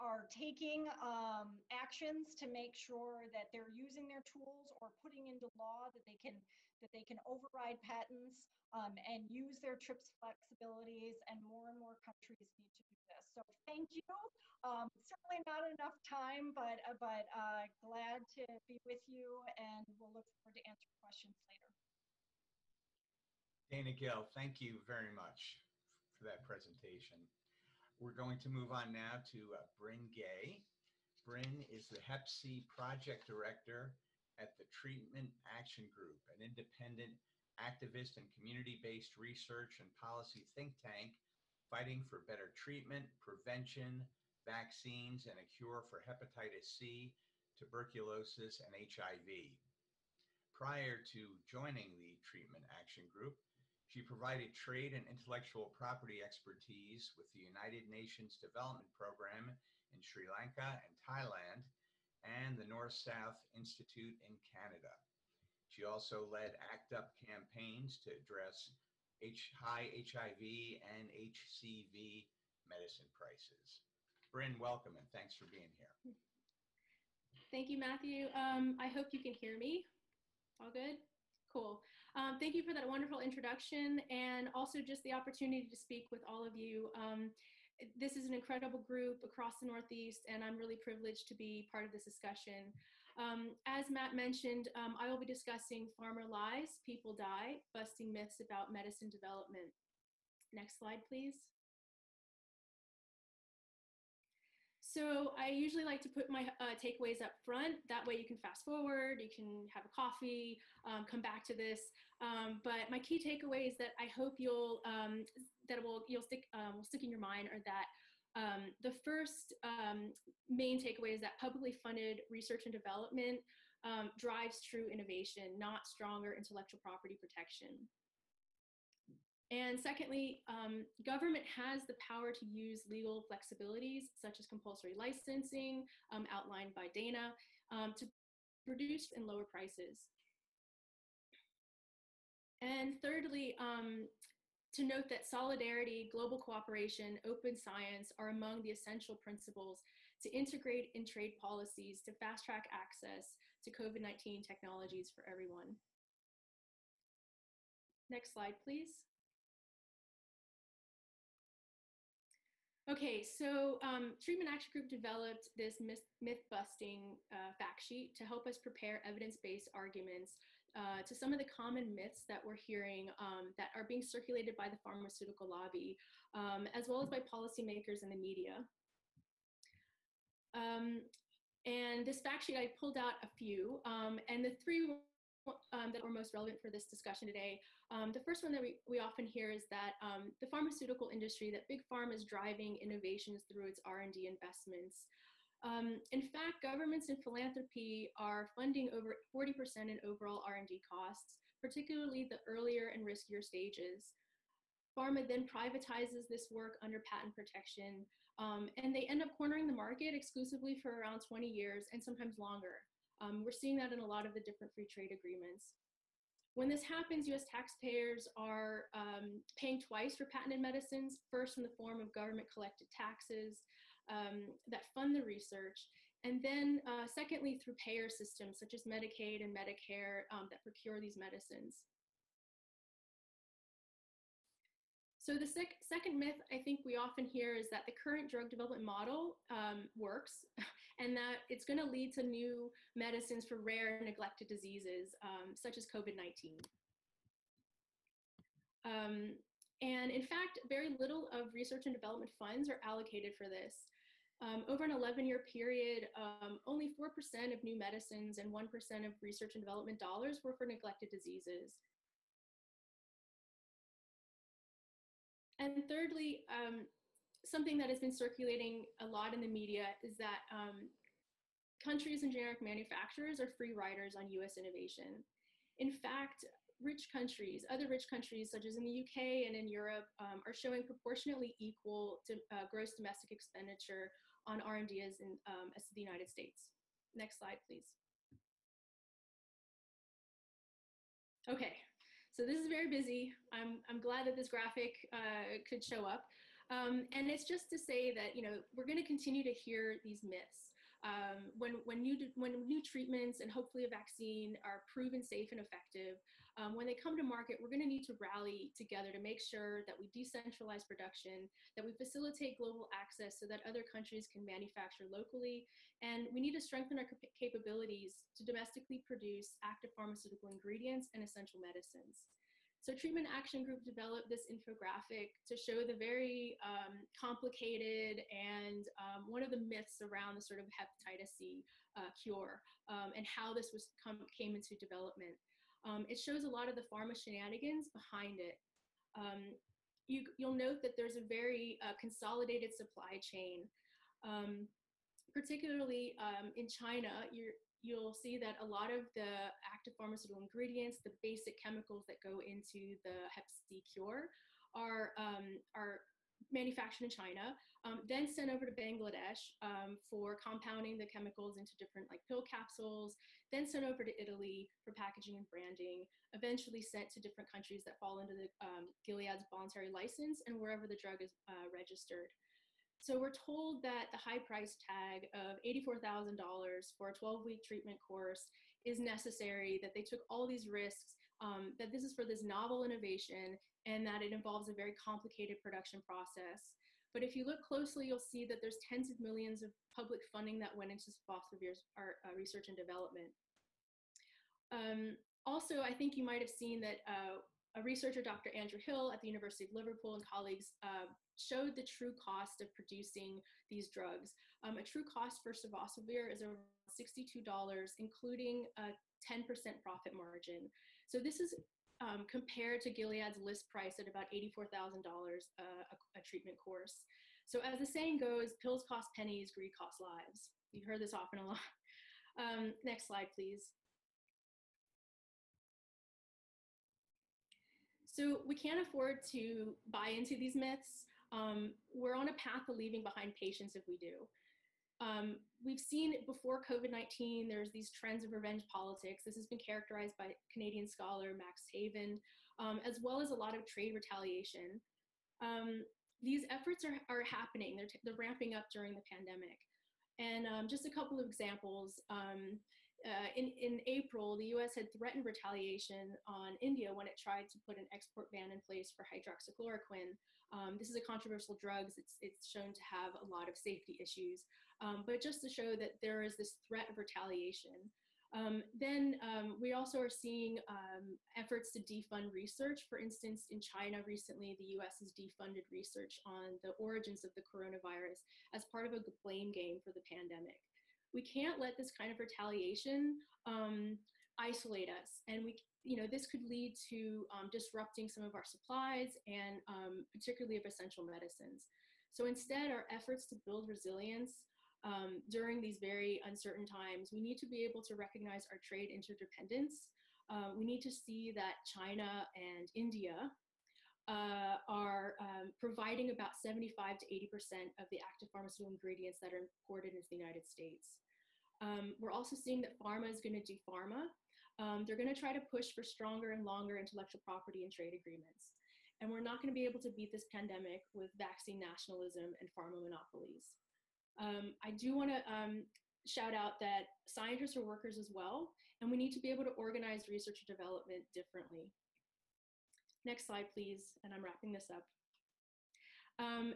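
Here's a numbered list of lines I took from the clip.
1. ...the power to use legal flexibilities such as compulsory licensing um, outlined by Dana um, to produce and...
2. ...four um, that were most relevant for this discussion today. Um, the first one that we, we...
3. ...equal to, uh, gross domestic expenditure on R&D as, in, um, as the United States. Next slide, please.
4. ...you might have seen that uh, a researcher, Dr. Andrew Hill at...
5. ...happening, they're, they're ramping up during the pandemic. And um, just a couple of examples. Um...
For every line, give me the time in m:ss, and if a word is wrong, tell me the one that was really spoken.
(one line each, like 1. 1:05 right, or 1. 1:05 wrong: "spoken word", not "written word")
1. 2:11 right
2. 3:04 wrong: "three", not "four"
3. 4:41 right
4. 6:36 right
5. 7:27 right.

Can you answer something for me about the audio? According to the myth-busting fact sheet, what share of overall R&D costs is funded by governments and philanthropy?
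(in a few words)
over 40%.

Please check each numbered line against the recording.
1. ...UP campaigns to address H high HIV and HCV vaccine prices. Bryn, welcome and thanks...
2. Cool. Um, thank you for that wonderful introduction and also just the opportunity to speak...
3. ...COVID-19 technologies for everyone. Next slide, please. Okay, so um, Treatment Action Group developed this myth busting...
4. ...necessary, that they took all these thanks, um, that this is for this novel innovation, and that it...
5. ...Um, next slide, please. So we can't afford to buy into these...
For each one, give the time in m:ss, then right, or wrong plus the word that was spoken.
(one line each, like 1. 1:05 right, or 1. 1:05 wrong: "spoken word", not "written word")
1. 1:06 wrong: "medicine", not "vaccine"
2. 1:21 right
3. 2:33 right
4. 6:18 wrong: "risks", not "thanks"
5. 7:02 right.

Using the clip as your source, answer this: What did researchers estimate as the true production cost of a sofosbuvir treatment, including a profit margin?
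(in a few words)
$62.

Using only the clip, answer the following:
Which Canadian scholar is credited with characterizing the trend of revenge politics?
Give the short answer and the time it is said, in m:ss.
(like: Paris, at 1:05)
Max Haiven, at 7:21.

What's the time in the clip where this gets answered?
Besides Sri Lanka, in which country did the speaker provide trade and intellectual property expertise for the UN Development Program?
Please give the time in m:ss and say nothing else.
1:01.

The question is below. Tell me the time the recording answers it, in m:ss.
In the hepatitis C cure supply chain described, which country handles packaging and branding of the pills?
6:04.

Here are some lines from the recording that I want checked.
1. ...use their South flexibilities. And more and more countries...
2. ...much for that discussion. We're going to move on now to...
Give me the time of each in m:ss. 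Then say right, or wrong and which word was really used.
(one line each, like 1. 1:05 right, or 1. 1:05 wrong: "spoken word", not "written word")
1. 0:09 wrong: "TRIPS", not "South"
2. 0:25 wrong: "presentation", not "discussion".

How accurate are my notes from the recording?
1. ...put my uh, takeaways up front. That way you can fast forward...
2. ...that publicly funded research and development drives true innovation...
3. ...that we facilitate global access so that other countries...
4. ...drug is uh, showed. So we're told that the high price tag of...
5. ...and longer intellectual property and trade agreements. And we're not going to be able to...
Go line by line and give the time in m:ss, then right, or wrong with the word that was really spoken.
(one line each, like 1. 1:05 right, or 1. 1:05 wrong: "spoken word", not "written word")
1. 1:46 right
2. 2:01 right
3. 5:11 right
4. 6:10 wrong: "registered", not "showed"
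5. 8:36 right.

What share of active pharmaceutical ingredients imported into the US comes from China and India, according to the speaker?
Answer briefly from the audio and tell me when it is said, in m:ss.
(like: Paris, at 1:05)
75 to 80%, at 8:26.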